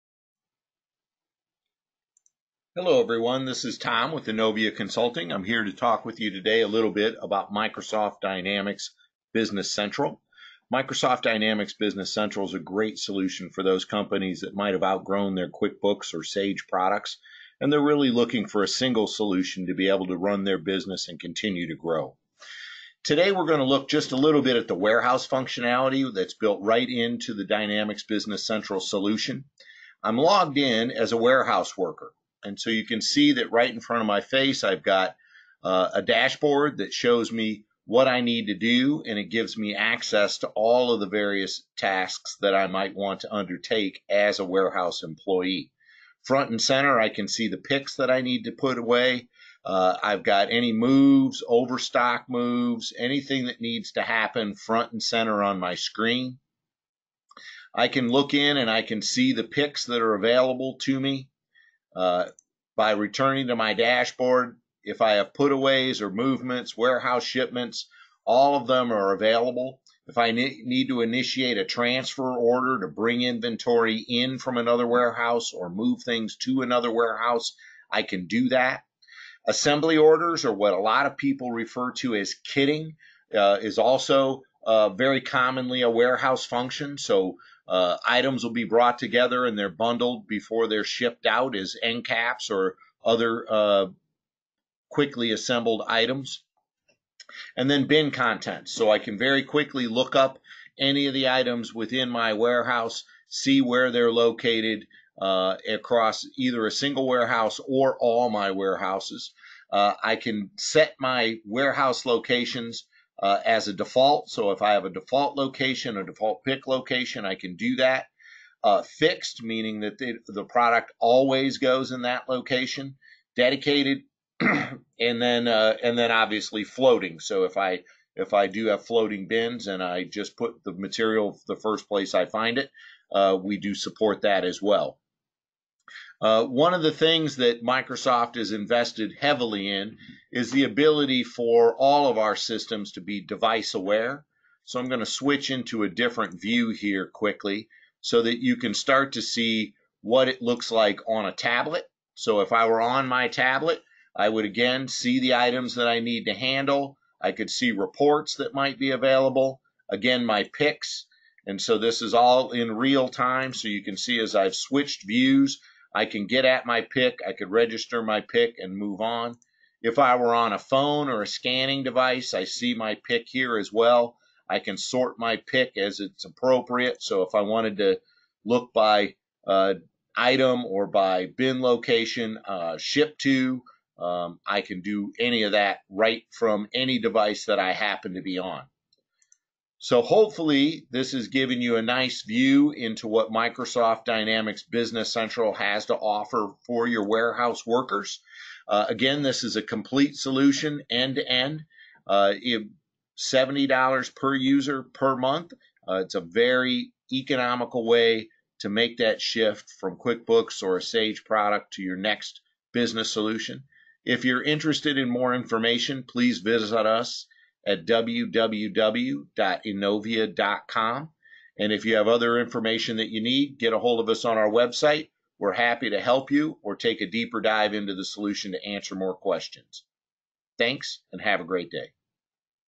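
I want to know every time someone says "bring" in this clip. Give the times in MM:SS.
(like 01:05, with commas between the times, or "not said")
01:12.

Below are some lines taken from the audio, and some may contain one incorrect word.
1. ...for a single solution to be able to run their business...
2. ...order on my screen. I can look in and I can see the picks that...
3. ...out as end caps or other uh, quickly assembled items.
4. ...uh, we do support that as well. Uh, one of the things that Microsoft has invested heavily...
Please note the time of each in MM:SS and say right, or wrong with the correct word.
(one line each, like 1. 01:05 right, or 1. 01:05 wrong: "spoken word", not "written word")
1. 00:18 right
2. 00:55 wrong: "center", not "order"
3. 01:31 right
4. 02:13 right.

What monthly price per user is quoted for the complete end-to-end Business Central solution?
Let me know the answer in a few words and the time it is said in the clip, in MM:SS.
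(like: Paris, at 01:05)
$70, at 03:23.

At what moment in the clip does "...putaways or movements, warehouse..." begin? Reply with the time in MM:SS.
01:05.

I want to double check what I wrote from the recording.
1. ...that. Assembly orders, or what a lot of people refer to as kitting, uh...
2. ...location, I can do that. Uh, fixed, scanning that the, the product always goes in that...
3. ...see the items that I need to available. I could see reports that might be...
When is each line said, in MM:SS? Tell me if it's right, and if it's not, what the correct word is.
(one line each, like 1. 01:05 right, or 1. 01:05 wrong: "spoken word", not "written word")
1. 01:18 right
2. 01:56 wrong: "meaning", not "scanning"
3. 02:34 wrong: "handle", not "available".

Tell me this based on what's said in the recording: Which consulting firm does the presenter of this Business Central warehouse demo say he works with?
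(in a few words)
Innovia Consulting.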